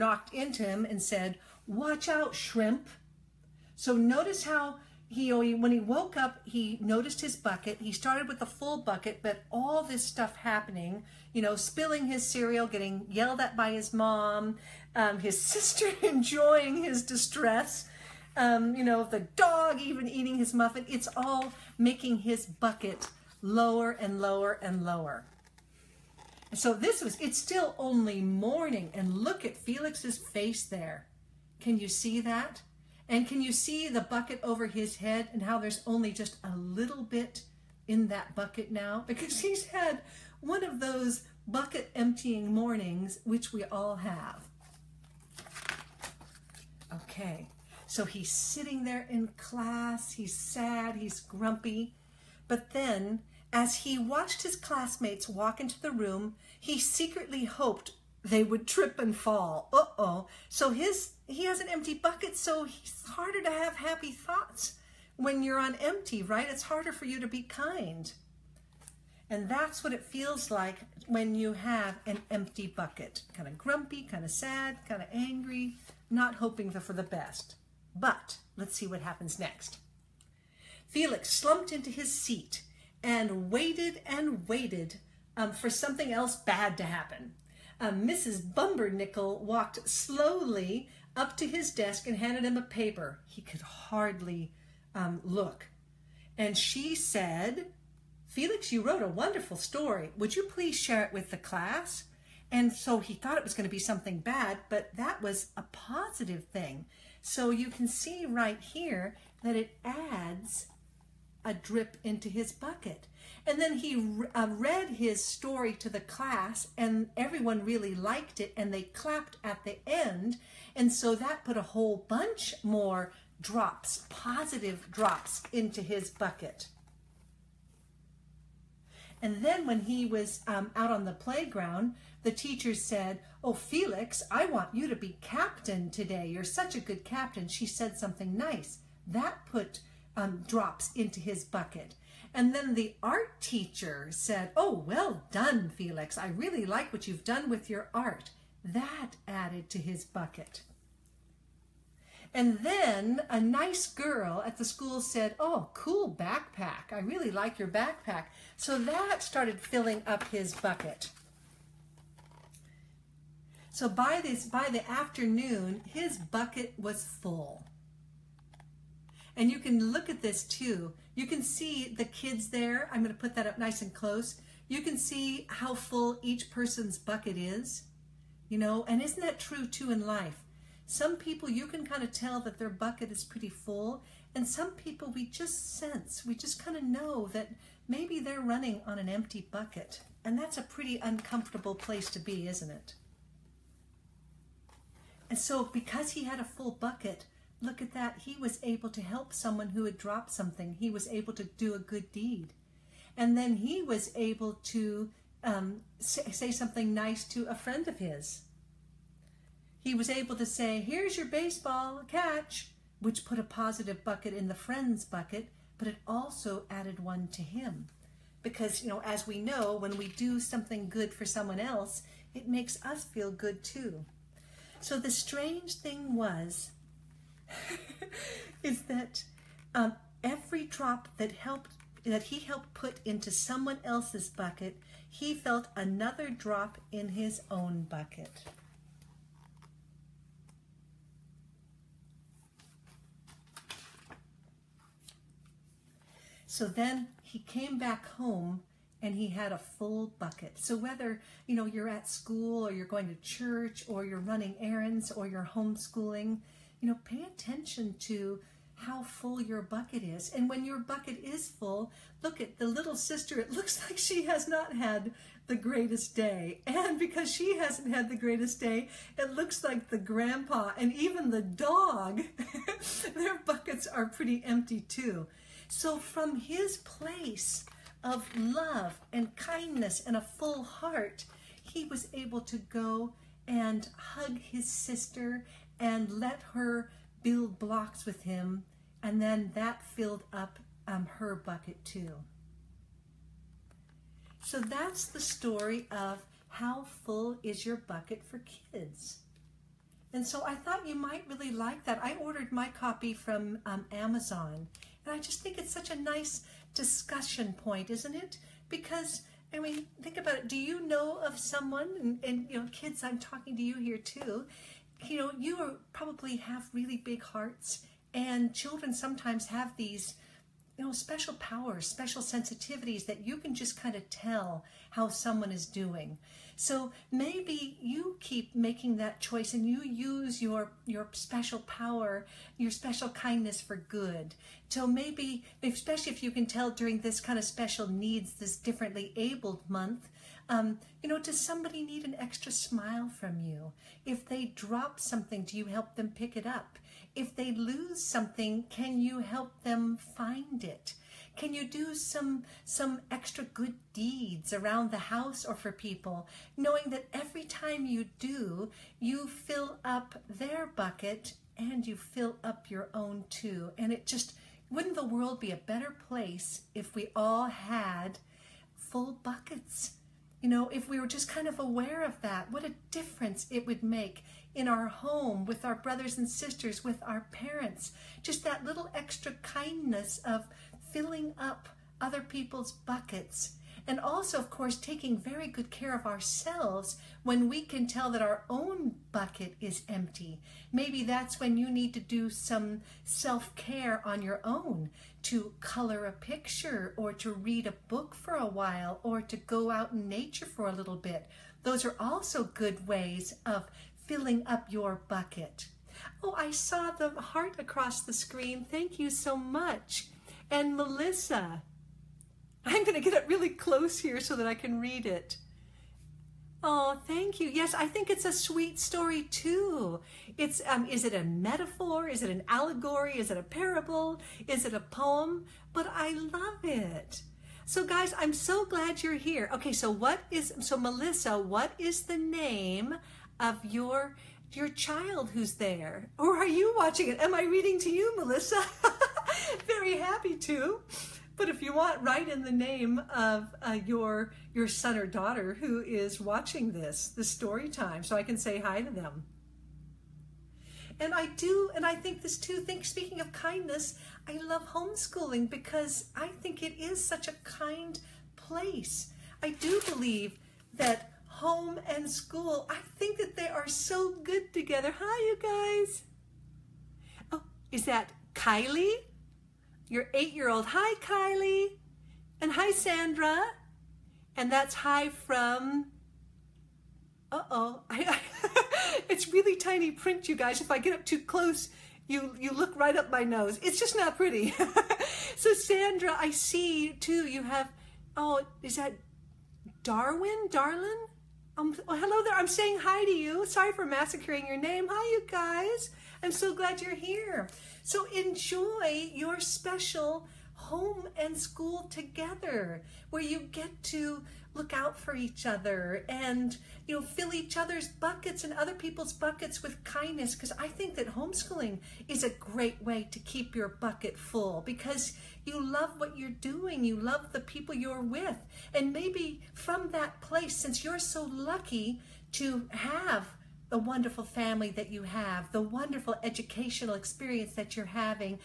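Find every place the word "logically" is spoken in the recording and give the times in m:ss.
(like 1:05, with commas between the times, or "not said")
not said.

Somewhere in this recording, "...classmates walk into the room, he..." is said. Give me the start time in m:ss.
0:54.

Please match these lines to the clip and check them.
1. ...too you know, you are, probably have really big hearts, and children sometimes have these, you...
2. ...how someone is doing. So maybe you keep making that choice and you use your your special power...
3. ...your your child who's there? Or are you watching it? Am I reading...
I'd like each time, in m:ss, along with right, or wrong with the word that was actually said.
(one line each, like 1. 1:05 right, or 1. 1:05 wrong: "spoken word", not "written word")
1. 5:13 right
2. 5:24 right
3. 7:13 right.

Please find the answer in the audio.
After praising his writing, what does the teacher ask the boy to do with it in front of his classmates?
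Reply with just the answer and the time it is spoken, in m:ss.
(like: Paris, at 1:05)
Share it with the class, at 1:40.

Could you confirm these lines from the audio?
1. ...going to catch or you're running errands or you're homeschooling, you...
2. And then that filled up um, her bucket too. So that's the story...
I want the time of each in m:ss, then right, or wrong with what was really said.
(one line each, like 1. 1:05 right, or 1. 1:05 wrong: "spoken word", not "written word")
1. 4:12 wrong: "church", not "catch"
2. 4:49 right.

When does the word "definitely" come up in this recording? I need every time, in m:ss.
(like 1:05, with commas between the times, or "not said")
not said.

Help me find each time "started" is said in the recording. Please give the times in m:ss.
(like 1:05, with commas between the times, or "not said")
0:07, 2:39.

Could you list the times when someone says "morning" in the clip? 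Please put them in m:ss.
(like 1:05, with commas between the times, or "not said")
0:28, 0:42.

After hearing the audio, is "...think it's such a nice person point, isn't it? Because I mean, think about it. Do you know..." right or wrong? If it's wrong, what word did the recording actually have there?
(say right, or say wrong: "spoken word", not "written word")
wrong: "discussion", not "person".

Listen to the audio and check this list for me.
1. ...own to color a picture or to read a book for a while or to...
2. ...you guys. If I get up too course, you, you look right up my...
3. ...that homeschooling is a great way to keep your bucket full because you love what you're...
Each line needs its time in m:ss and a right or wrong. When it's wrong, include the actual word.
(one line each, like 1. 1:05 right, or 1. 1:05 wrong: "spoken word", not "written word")
1. 6:34 right
2. 8:00 wrong: "close", not "course"
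3. 8:30 right.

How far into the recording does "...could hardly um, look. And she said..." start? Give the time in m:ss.
1:33.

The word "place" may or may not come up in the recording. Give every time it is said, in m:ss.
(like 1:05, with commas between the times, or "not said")
3:11, 4:36, 6:06, 7:38, 8:40.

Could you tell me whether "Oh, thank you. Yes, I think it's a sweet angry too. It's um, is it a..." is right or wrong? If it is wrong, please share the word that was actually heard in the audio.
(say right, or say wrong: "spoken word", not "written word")
wrong: "story", not "angry".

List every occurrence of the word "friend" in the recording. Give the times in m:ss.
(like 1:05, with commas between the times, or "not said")
3:27, 3:34.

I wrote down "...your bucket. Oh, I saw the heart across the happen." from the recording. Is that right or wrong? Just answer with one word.
wrong.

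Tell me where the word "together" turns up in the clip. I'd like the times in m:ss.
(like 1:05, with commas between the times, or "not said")
7:44, 8:21.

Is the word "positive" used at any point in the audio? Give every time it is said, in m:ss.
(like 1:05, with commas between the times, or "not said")
1:45, 2:04, 3:33.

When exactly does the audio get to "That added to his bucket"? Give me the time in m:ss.
2:28.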